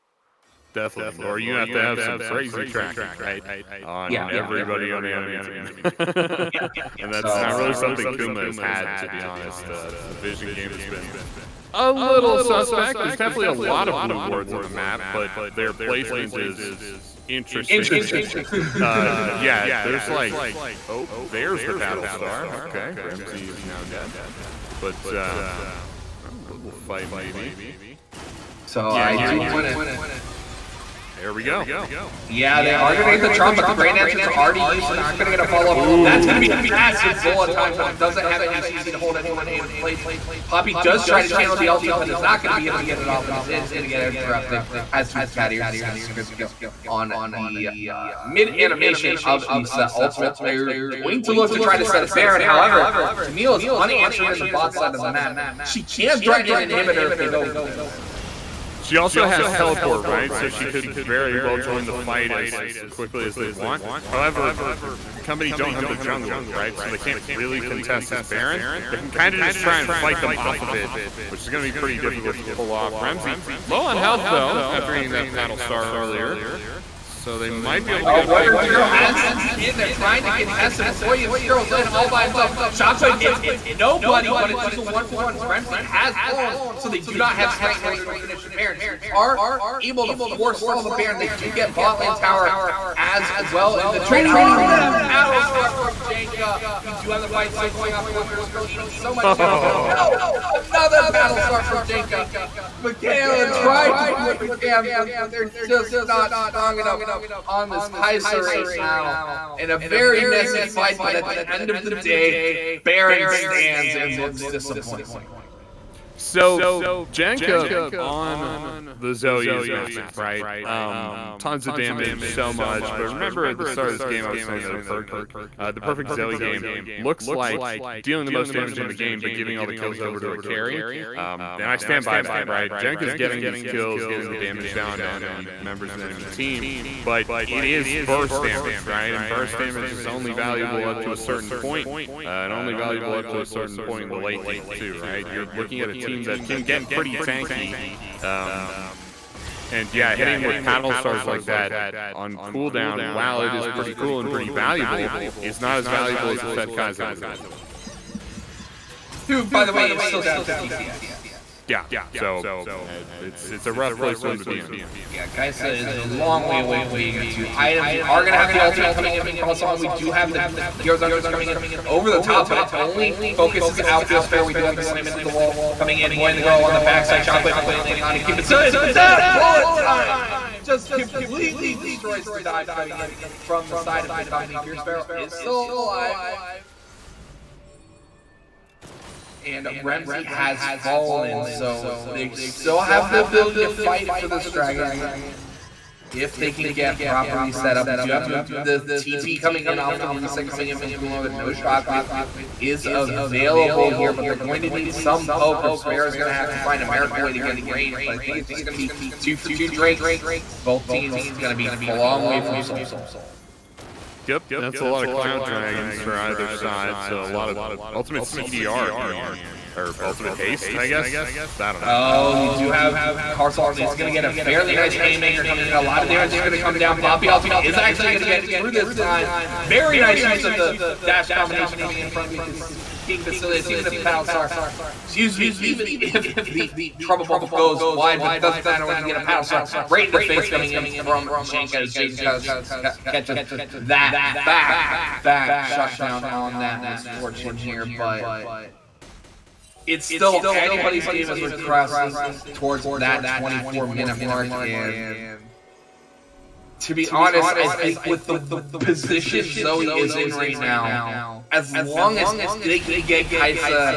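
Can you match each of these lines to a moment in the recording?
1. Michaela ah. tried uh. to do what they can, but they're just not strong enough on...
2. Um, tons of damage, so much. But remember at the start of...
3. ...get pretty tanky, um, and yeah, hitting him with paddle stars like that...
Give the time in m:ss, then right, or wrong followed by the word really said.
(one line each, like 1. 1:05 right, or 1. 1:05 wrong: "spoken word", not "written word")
1. 1:42 right
2. 2:00 right
3. 2:26 right.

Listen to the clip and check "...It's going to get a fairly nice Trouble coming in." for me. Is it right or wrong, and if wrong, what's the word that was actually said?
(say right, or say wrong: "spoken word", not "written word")
wrong: "Haymaker", not "Trouble".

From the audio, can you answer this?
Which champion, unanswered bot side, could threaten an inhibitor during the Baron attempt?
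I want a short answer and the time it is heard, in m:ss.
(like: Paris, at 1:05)
Camille, at 0:53.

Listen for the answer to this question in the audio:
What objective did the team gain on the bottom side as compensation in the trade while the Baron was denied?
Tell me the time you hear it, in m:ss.
1:31.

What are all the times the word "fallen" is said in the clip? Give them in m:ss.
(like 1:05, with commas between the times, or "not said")
1:26, 3:10.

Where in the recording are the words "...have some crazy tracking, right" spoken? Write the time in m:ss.
0:01.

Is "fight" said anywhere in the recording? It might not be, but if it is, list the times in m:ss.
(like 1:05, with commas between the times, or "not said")
0:26, 1:01, 1:09, 1:37, 1:50, 3:13.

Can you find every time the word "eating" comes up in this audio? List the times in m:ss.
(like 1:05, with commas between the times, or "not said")
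1:14, 1:38.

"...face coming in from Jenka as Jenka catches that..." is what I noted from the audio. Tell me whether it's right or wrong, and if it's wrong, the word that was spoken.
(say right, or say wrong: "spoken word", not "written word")
right.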